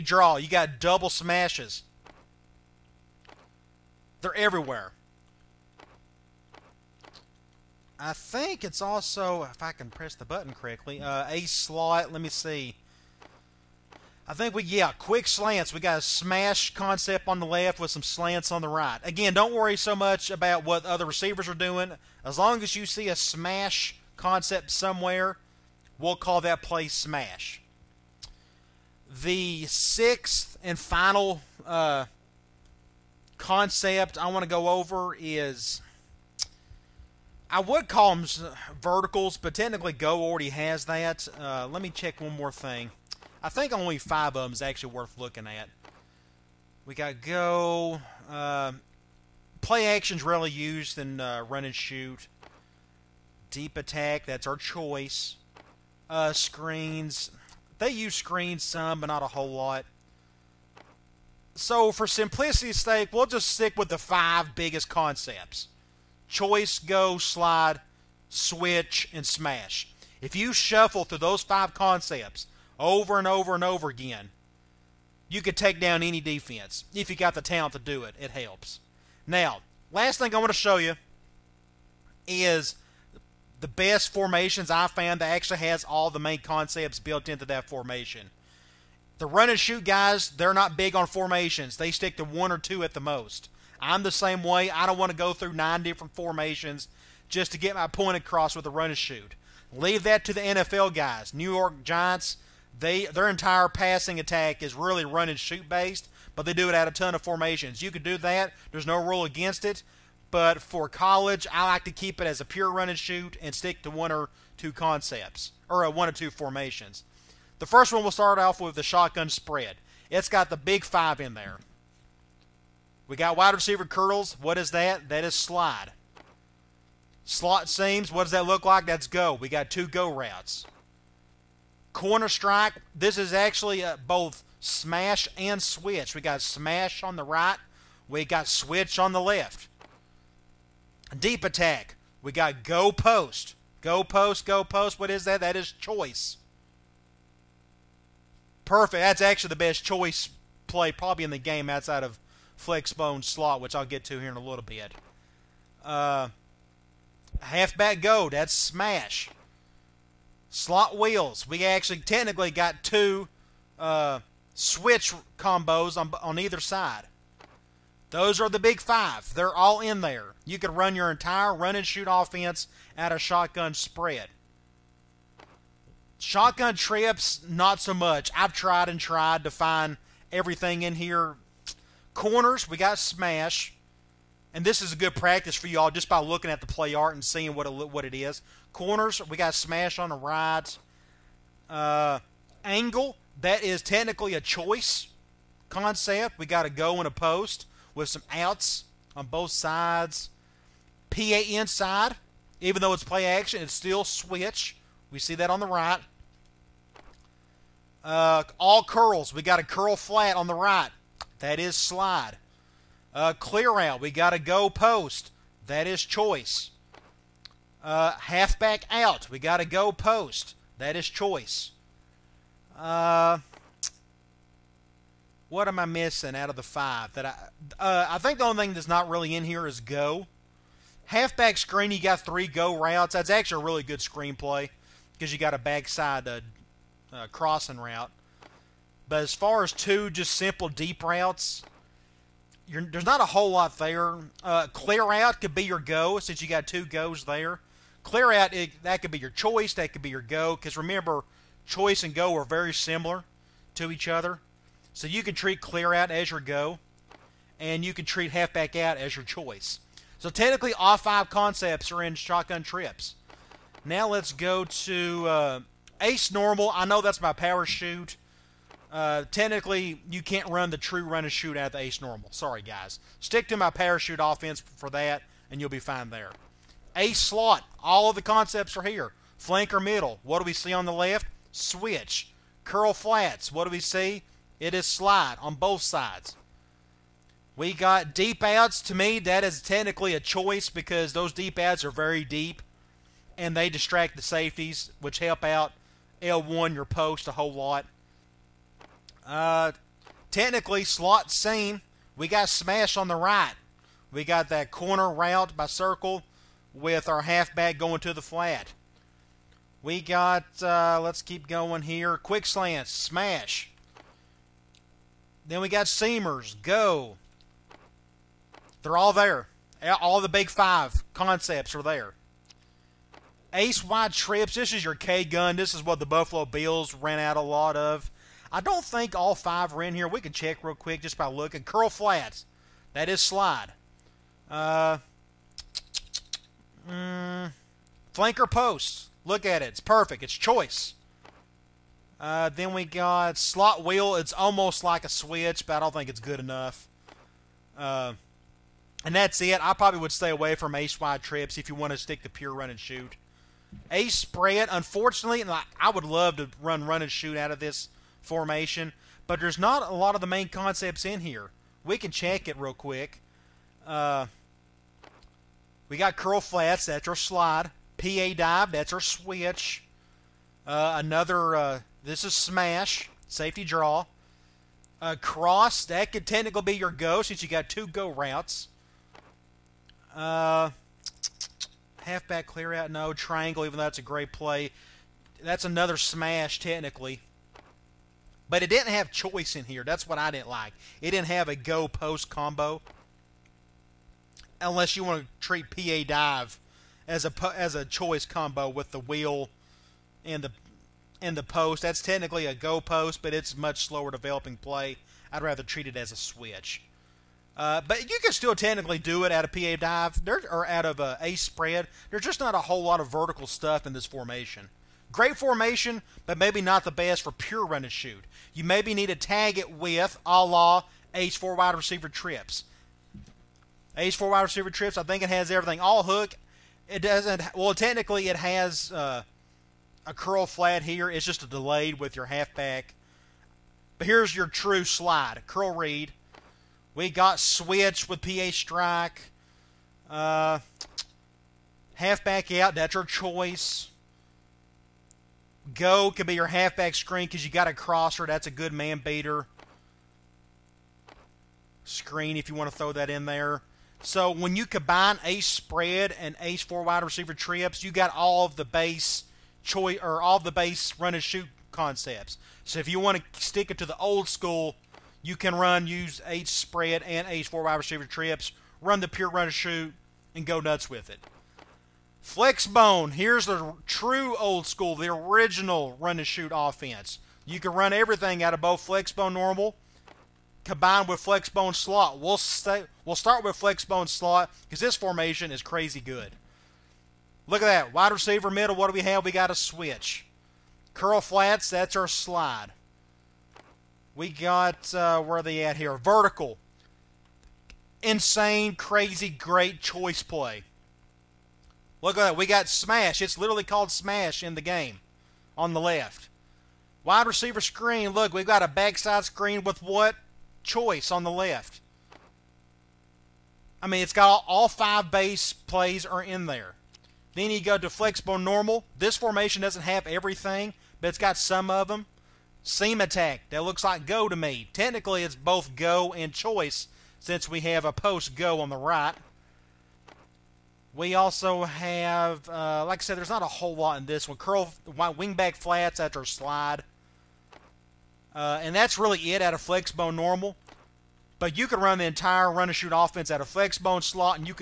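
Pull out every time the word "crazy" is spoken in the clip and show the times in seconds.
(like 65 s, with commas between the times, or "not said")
485 s, 498 s.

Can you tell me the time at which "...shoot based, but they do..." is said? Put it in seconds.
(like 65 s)
105 s.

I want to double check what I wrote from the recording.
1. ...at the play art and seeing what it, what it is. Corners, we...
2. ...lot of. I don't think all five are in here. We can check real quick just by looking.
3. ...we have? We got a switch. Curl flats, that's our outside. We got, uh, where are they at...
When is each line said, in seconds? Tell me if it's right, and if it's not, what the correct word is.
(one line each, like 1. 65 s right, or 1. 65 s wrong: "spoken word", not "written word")
1. 186 s right
2. 327 s right
3. 488 s wrong: "slide", not "outside".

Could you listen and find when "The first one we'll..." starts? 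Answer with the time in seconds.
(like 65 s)
117 s.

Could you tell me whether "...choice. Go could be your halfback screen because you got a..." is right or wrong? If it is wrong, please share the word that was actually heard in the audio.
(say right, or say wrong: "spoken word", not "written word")
right.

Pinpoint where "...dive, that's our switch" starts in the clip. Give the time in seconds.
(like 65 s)
368 s.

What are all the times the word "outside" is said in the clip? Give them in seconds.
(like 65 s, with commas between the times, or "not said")
151 s.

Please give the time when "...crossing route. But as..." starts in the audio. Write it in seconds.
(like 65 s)
237 s.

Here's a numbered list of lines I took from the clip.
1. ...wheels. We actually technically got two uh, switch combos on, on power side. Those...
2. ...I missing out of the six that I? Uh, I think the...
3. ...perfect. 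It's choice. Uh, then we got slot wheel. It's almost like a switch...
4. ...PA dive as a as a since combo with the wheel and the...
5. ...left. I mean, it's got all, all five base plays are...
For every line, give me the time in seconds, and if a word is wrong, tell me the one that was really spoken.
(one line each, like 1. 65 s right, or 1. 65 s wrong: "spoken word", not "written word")
1. 160 s wrong: "either", not "power"
2. 225 s wrong: "five", not "six"
3. 339 s right
4. 395 s wrong: "choice", not "since"
5. 511 s right.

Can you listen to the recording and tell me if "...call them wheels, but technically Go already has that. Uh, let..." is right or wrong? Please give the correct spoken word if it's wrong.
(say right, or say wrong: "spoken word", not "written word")
wrong: "verticals", not "wheels".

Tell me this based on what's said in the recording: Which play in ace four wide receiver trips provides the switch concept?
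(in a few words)
PA strike.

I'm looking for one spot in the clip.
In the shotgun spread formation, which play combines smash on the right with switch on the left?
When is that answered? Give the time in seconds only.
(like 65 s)
131 s.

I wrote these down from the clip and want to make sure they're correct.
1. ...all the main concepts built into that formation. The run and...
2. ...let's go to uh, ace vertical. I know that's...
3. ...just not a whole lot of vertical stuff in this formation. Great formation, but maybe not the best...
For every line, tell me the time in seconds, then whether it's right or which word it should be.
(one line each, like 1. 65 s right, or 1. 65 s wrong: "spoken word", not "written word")
1. 85 s right
2. 264 s wrong: "normal", not "vertical"
3. 412 s right.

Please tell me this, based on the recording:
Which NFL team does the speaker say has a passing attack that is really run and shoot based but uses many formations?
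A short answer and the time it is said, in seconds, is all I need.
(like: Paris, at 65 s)
New York Giants, at 101 s.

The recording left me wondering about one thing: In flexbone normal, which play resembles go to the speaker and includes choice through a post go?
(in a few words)
Seam attack.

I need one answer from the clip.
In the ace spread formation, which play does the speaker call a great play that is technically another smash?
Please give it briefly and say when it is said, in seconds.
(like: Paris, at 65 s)
Triangle, at 383 s.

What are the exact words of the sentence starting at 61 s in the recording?
So, for simplicity's sake, we'll just stick with the five biggest concepts choice, go, slide, switch, and smash.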